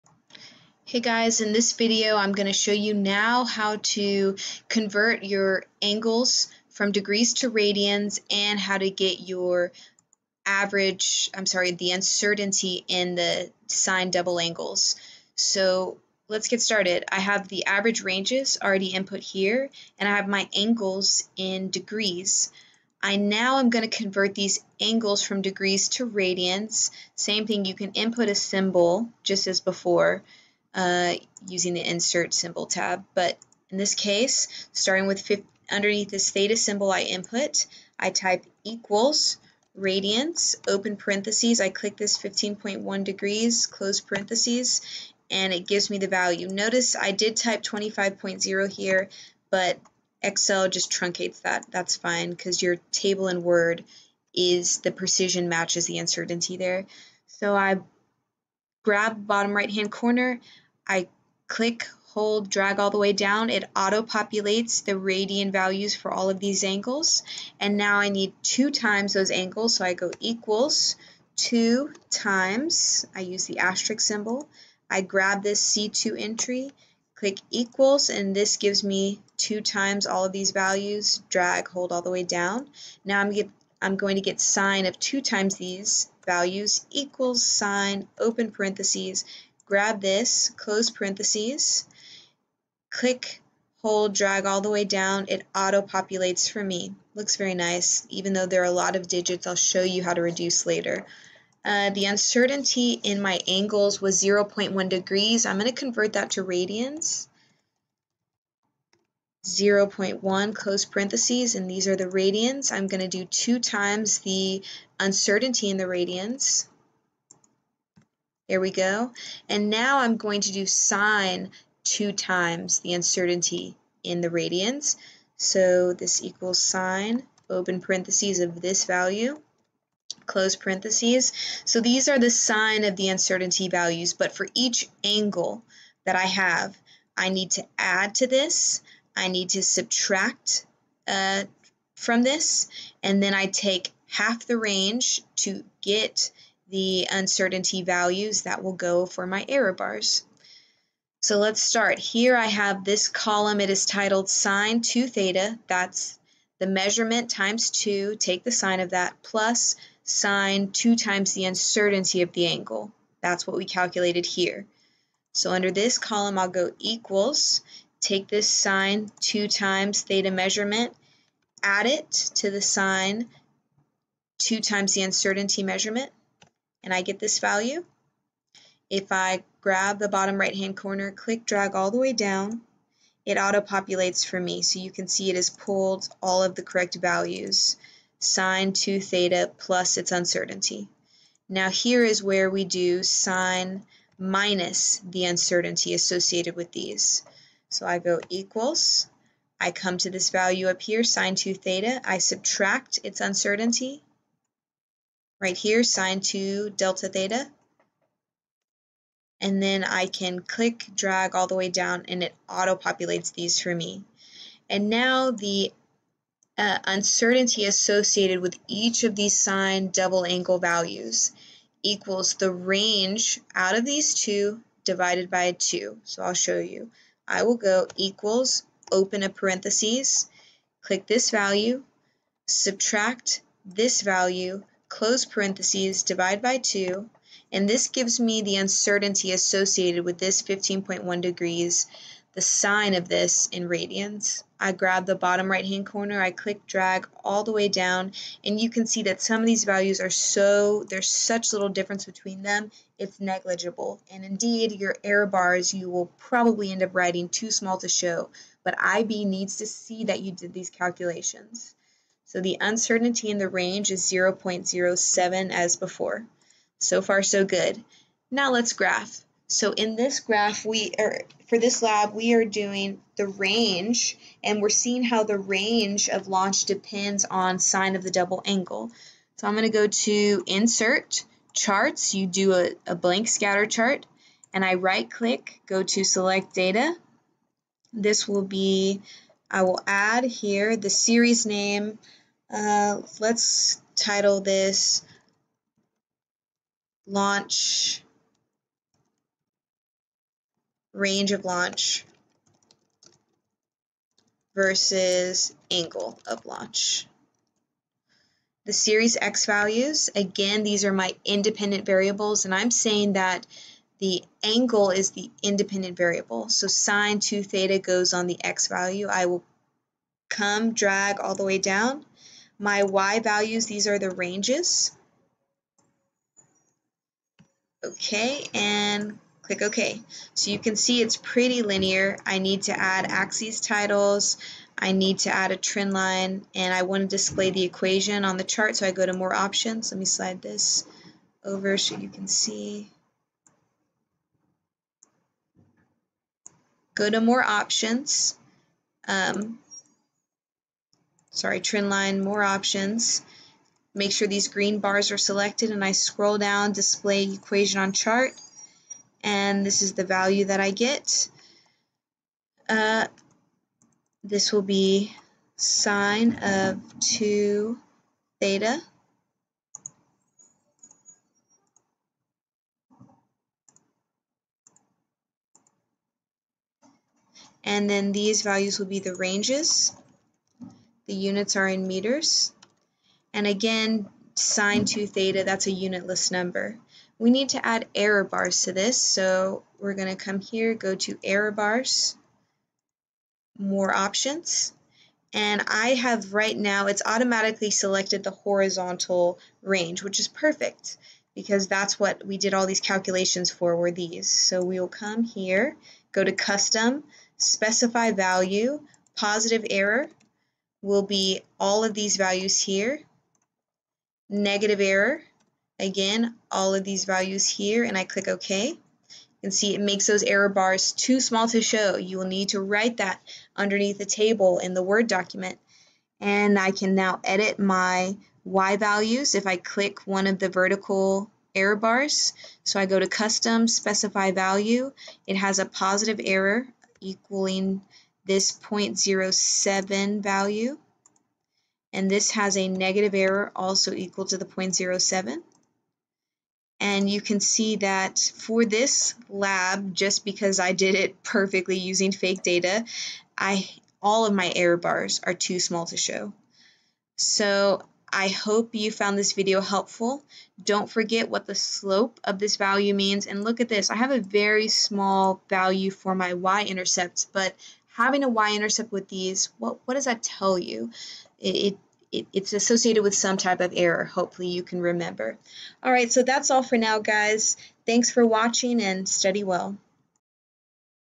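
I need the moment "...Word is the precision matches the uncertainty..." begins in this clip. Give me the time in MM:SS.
00:53.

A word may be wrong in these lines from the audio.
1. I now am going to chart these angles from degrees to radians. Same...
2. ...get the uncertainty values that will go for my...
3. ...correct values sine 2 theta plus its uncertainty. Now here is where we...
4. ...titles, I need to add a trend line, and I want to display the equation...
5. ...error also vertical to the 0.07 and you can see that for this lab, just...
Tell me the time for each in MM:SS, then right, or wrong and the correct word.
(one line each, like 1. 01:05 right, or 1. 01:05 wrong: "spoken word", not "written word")
1. 00:23 wrong: "convert", not "chart"
2. 02:25 right
3. 03:06 right
4. 05:33 right
5. 07:23 wrong: "equal", not "vertical".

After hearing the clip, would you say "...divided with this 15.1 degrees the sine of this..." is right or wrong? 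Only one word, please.
wrong.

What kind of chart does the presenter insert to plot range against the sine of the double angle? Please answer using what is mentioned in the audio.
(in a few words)
scatter chart.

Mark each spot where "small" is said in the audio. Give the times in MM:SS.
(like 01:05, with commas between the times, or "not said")
04:17, 07:01, 07:35, 07:44.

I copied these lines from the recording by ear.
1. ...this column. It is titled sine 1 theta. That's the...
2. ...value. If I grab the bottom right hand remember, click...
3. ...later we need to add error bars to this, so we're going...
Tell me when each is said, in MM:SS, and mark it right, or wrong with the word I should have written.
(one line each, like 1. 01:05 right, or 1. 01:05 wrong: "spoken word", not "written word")
1. 02:32 wrong: "2", not "1"
2. 02:57 wrong: "corner", not "remember"
3. 06:26 wrong: "number", not "later".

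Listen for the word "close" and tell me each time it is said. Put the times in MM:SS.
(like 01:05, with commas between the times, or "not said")
00:43, 01:30, 01:50, 02:10, 03:54.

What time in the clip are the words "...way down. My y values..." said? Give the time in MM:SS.
05:21.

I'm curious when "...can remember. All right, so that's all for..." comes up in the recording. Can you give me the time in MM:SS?
07:54.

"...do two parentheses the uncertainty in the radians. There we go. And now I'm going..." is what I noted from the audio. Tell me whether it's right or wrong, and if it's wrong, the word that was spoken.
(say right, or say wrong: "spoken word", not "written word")
wrong: "times", not "parentheses".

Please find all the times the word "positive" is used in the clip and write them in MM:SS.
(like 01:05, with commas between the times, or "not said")
06:49, 07:15.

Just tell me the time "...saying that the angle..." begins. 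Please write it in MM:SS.
05:12.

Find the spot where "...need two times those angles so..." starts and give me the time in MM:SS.
01:08.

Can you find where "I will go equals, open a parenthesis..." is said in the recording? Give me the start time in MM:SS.
03:47.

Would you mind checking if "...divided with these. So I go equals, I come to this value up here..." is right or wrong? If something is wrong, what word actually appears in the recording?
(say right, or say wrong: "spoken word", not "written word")
wrong: "associated", not "divided".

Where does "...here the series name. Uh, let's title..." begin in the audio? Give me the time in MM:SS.
04:50.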